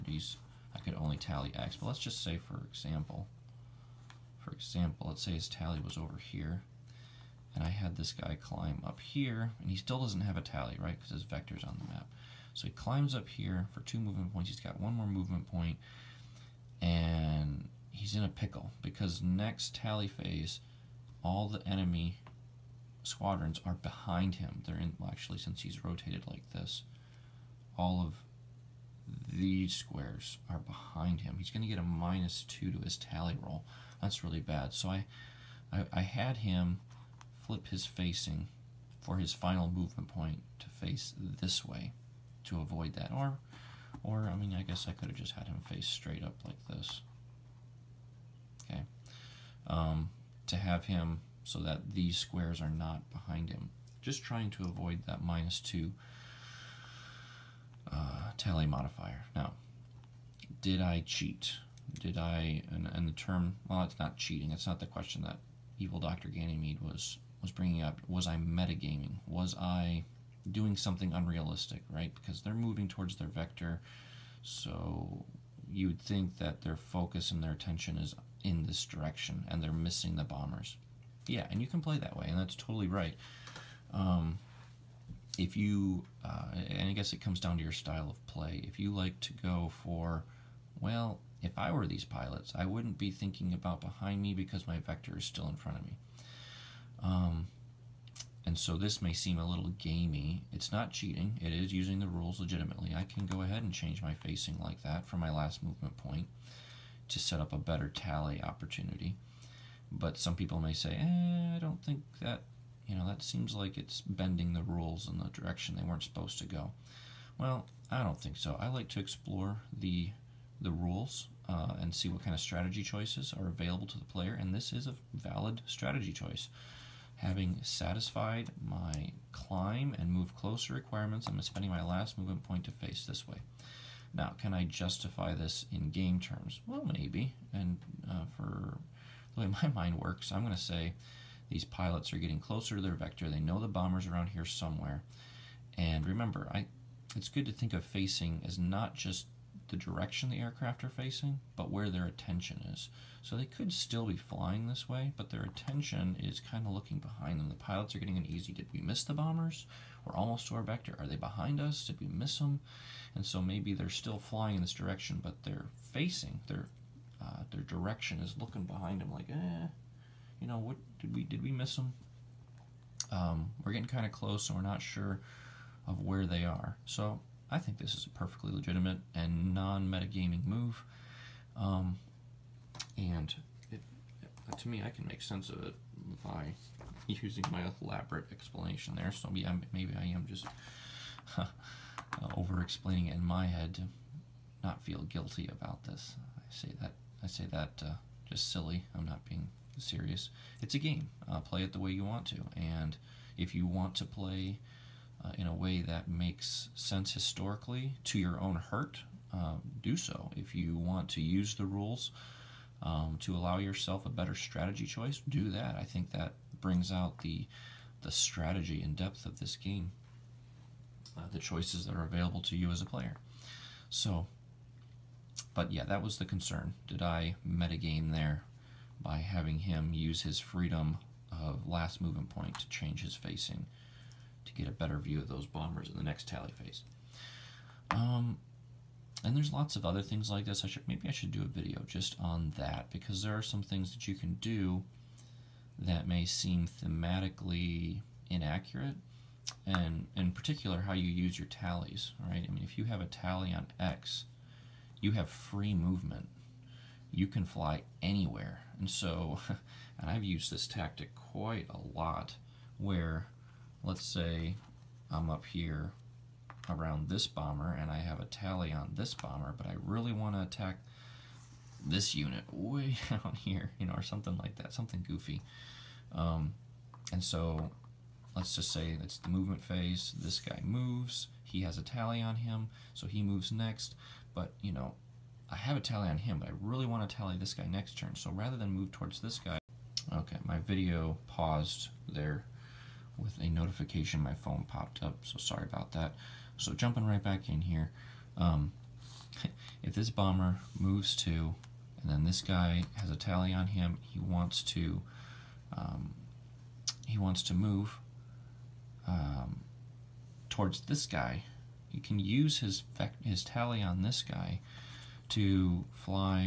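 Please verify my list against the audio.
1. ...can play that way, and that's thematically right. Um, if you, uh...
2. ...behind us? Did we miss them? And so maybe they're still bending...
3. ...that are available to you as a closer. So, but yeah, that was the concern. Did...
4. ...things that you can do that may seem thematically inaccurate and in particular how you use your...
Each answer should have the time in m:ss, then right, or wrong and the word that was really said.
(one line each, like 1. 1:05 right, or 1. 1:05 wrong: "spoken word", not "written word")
1. 1:21 wrong: "totally", not "thematically"
2. 2:41 wrong: "flying", not "bending"
3. 3:41 wrong: "player", not "closer"
4. 4:03 right.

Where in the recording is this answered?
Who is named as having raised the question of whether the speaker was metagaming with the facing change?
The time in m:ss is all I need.
1:05.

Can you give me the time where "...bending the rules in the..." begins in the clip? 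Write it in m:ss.
1:54.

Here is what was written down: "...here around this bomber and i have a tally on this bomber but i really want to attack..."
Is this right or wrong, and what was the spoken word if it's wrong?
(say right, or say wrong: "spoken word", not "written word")
right.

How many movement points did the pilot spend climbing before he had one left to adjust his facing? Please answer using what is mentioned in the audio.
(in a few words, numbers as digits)
2.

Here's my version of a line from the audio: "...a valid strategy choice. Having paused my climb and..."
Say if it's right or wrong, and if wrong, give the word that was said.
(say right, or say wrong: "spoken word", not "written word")
wrong: "satisfied", not "paused".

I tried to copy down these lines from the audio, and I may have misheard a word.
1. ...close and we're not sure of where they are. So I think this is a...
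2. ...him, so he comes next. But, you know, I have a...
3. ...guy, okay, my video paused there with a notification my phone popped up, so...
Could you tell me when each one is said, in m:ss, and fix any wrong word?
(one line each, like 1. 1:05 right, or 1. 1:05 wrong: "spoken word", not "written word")
1. 2:54 right
2. 4:42 wrong: "moves", not "comes"
3. 4:49 right.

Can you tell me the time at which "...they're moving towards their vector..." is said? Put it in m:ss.
1:12.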